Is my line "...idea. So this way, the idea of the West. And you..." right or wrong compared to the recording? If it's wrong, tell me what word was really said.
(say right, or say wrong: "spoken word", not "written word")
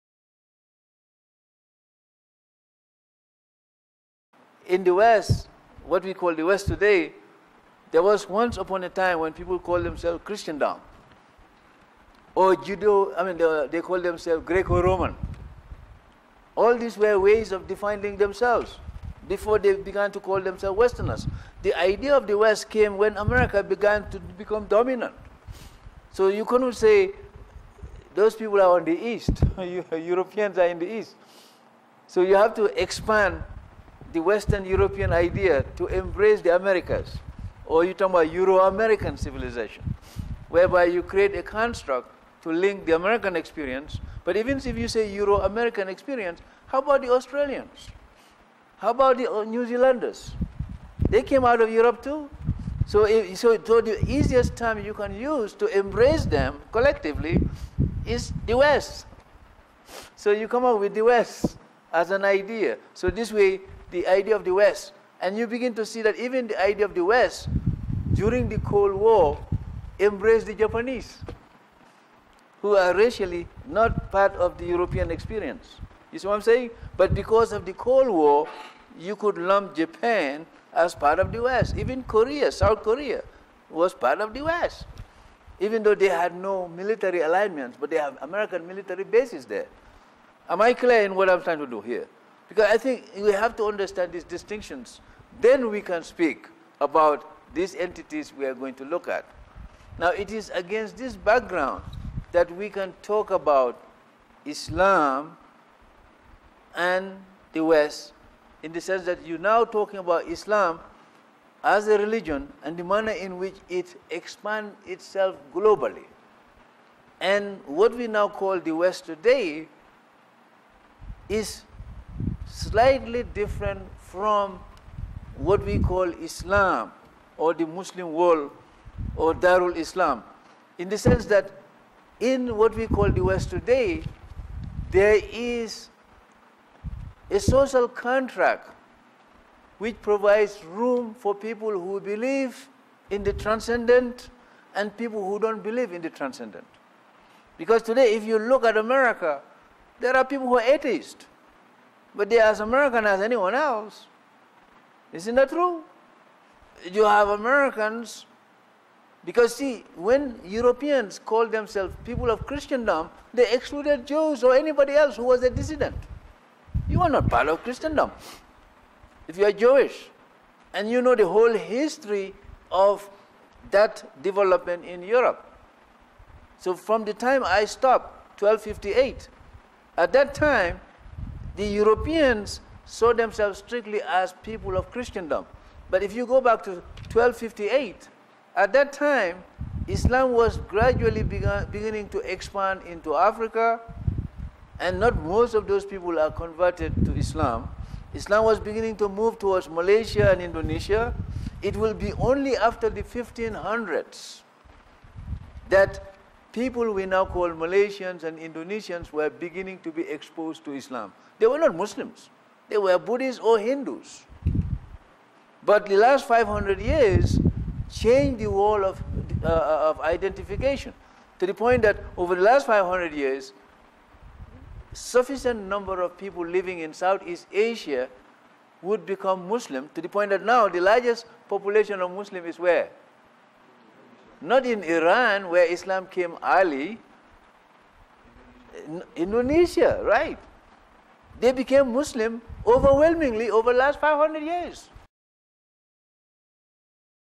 right.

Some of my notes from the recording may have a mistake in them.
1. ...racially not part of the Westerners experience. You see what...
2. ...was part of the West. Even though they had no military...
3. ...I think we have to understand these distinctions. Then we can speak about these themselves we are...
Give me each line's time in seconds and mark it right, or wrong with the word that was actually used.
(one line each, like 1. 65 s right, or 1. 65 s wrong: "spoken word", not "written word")
1. 72 s wrong: "European", not "Westerners"
2. 83 s right
3. 92 s wrong: "entities", not "themselves".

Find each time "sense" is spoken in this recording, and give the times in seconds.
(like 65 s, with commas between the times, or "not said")
108 s, 130 s.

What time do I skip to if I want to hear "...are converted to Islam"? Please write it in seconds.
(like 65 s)
196 s.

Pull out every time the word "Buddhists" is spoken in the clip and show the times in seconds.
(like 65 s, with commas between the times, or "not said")
212 s.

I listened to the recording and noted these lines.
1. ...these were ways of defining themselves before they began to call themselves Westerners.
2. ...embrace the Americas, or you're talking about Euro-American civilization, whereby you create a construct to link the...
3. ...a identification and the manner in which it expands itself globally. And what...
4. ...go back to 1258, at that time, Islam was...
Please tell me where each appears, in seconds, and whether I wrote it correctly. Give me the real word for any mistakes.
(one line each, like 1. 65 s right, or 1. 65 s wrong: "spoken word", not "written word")
1. 16 s right
2. 35 s right
3. 111 s wrong: "religion", not "identification"
4. 186 s right.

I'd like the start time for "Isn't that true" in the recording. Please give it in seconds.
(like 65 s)
155 s.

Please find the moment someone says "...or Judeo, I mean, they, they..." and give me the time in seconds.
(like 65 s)
12 s.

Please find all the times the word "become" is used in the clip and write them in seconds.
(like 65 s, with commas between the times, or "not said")
24 s, 229 s.